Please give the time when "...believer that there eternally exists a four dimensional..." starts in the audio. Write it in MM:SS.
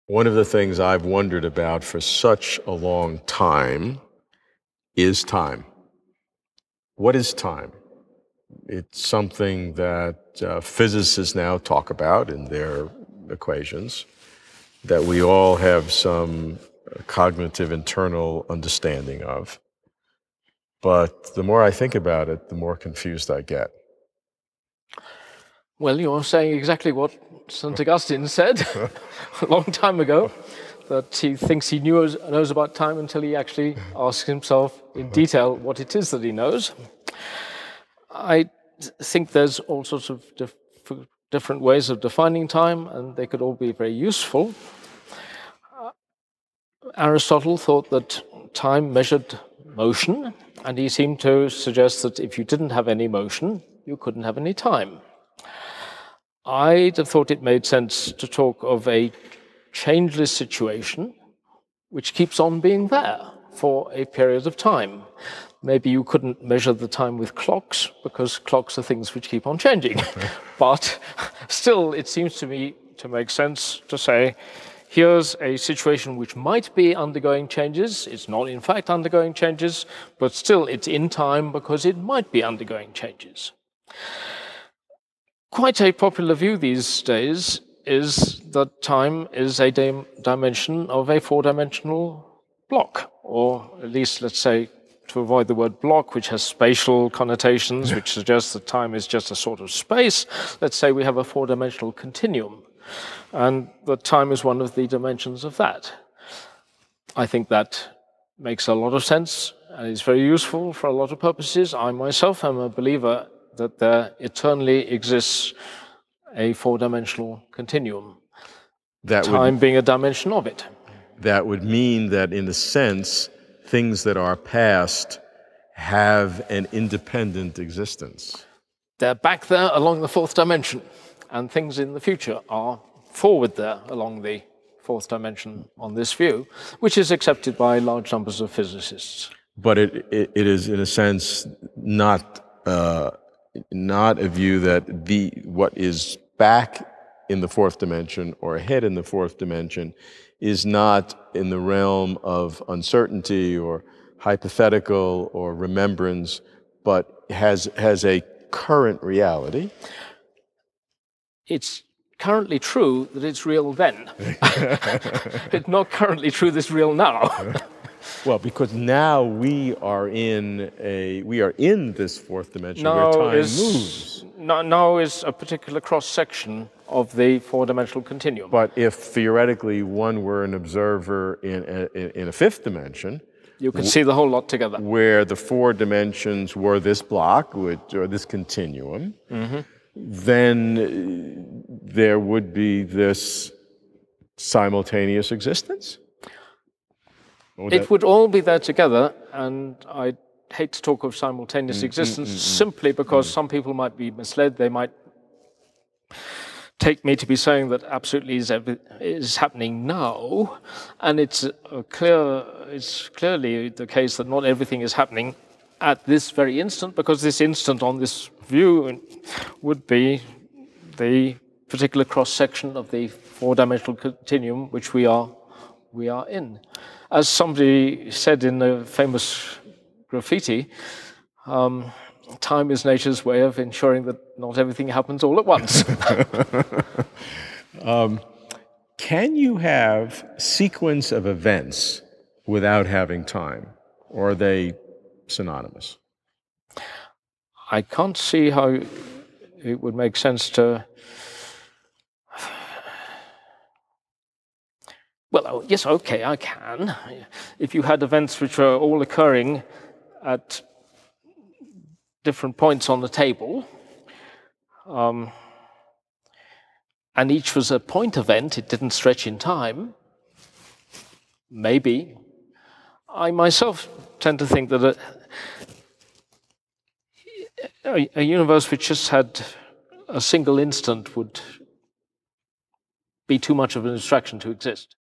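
01:52.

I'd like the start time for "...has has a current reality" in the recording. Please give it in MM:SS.
02:37.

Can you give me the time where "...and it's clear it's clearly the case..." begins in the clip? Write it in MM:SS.
03:30.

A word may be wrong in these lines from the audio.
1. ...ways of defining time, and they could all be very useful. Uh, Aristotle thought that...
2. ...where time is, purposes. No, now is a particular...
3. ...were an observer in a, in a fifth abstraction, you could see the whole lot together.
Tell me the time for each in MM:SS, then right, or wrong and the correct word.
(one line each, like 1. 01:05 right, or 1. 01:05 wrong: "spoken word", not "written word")
1. 00:41 right
2. 02:53 wrong: "moves", not "purposes"
3. 03:00 wrong: "dimension", not "abstraction".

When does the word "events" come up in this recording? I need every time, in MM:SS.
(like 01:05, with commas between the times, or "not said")
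04:01, 04:18, 04:28.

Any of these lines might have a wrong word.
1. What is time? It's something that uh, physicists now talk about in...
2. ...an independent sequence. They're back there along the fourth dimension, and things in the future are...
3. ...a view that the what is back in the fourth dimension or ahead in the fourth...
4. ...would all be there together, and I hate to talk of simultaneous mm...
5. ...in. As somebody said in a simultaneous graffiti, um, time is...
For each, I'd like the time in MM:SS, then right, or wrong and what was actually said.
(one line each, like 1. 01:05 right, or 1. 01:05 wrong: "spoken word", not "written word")
1. 00:06 right
2. 02:06 wrong: "existence", not "sequence"
3. 02:24 right
4. 03:17 right
5. 03:46 wrong: "famous", not "simultaneous".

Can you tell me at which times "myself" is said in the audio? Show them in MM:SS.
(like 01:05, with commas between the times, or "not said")
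01:51, 04:33.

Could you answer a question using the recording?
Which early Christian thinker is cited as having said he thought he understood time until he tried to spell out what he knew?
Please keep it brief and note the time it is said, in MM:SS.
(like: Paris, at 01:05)
St. Augustine, at 00:27.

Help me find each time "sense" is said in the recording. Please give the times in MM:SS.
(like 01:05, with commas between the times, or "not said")
00:57, 01:13, 01:49, 02:02, 02:20, 04:10.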